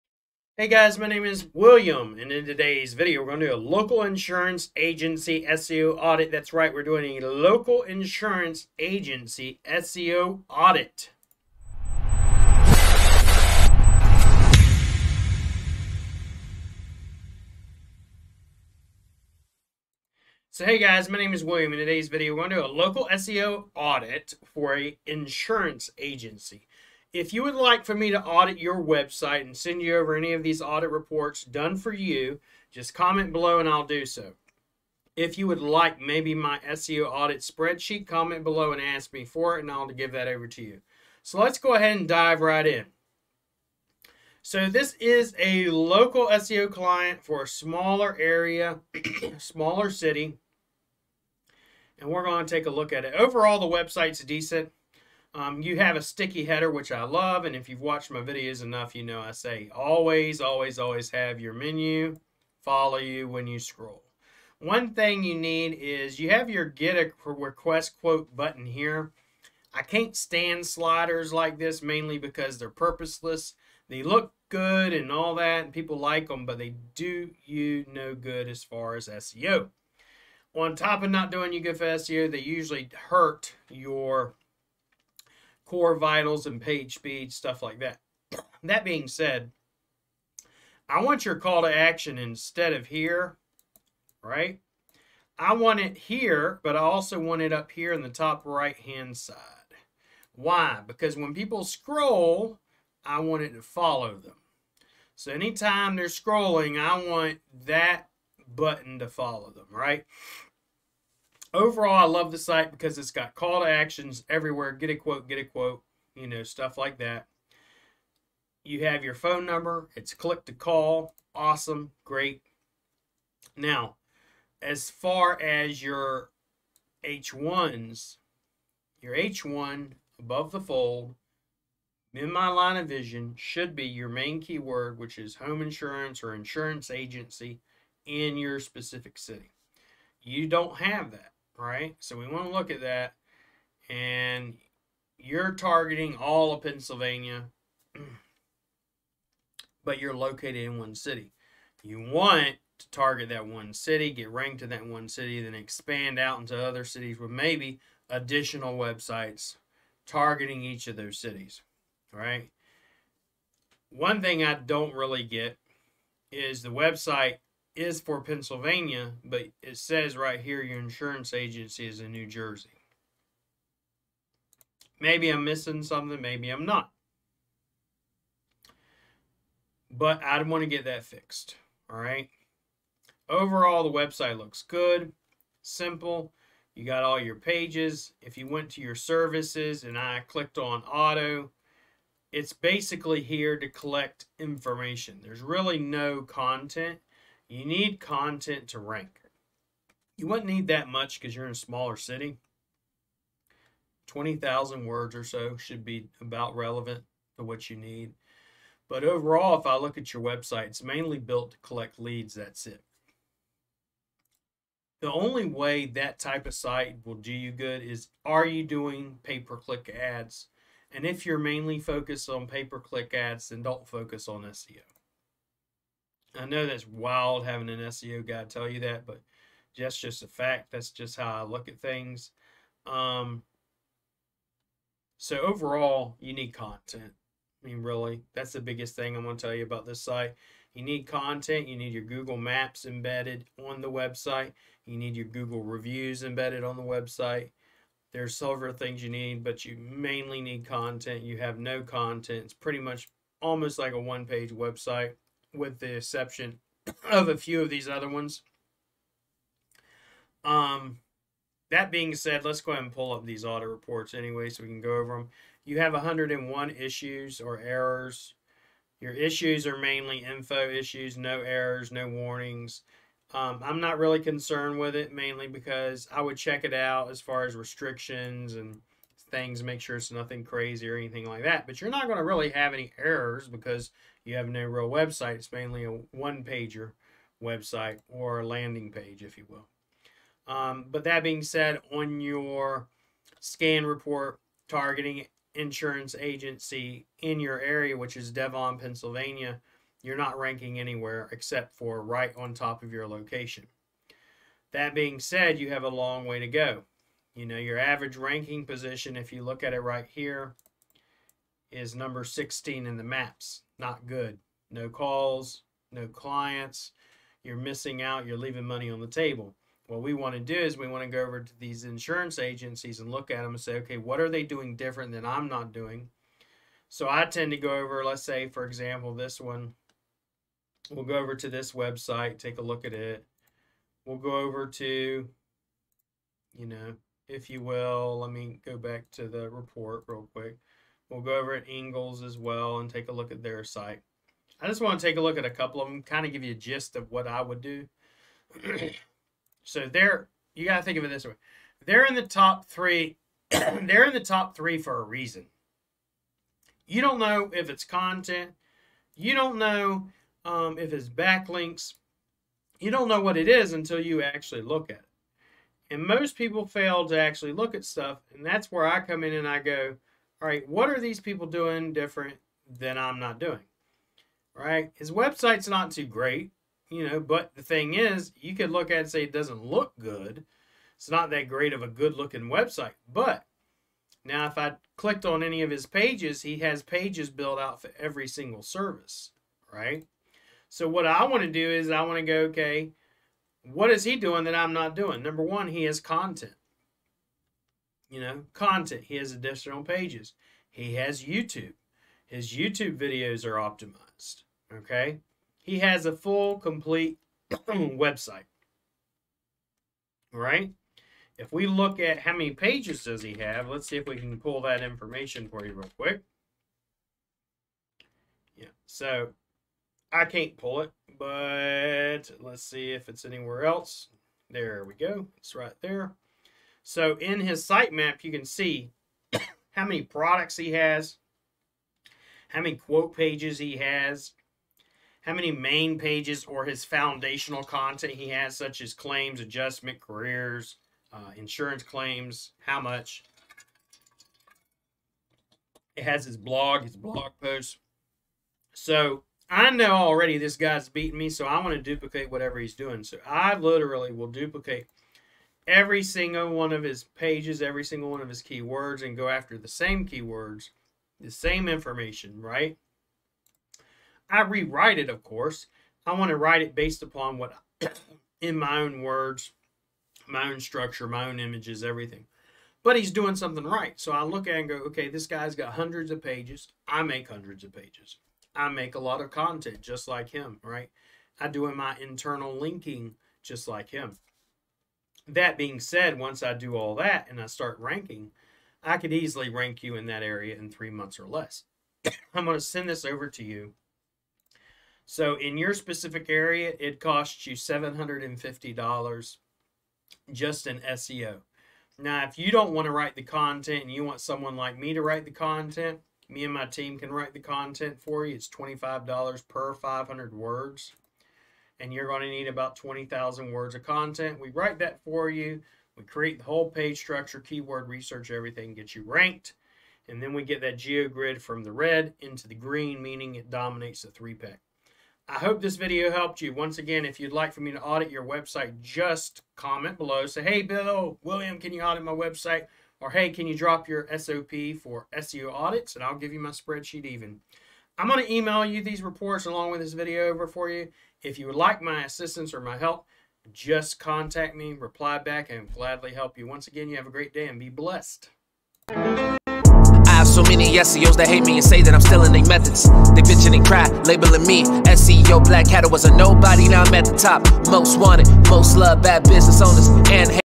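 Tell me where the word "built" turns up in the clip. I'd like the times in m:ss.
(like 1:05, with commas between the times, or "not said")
3:31, 6:27.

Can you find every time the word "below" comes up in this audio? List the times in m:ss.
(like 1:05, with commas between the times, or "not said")
0:33, 0:38, 8:49.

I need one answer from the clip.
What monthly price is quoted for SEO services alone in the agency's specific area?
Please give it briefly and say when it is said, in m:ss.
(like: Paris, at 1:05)
$750, at 8:17.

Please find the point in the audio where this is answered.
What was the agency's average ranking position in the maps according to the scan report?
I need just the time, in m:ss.
5:11.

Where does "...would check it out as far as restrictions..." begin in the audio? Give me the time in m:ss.
4:36.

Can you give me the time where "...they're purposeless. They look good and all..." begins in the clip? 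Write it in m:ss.
1:12.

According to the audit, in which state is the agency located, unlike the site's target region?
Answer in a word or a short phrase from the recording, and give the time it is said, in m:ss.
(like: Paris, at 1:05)
New Jersey, at 2:52.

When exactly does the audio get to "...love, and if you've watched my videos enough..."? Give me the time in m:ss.
0:57.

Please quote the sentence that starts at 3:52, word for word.
Um, so overall, you need content.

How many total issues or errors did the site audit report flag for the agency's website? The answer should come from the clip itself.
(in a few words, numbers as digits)
101.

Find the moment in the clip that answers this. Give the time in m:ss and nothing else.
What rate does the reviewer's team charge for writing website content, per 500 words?
8:28.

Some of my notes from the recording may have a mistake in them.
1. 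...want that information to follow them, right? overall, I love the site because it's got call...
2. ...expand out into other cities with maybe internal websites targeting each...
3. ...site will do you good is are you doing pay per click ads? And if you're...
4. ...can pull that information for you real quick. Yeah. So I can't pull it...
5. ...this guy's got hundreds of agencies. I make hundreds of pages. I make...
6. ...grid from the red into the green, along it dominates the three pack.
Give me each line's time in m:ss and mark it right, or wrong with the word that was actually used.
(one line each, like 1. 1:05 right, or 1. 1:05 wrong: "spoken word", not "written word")
1. 1:47 wrong: "button", not "information"
2. 2:35 wrong: "additional", not "internal"
3. 3:36 right
4. 6:54 right
5. 7:55 wrong: "pages", not "agencies"
6. 8:41 wrong: "meaning", not "along".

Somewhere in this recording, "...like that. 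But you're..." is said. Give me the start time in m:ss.
4:41.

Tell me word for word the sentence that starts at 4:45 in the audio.
It's mainly a one-pager website or a landing page, if you will.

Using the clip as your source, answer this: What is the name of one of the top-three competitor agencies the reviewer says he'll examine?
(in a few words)
Ingles.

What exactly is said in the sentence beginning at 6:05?
And most people fail to actually look at stuff.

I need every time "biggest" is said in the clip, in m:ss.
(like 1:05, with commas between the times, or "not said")
3:58.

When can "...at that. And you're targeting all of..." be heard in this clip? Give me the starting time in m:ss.
2:22.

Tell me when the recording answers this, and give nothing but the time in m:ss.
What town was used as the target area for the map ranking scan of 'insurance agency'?
4:58.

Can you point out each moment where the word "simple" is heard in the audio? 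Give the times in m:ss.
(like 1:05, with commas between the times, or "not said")
3:05.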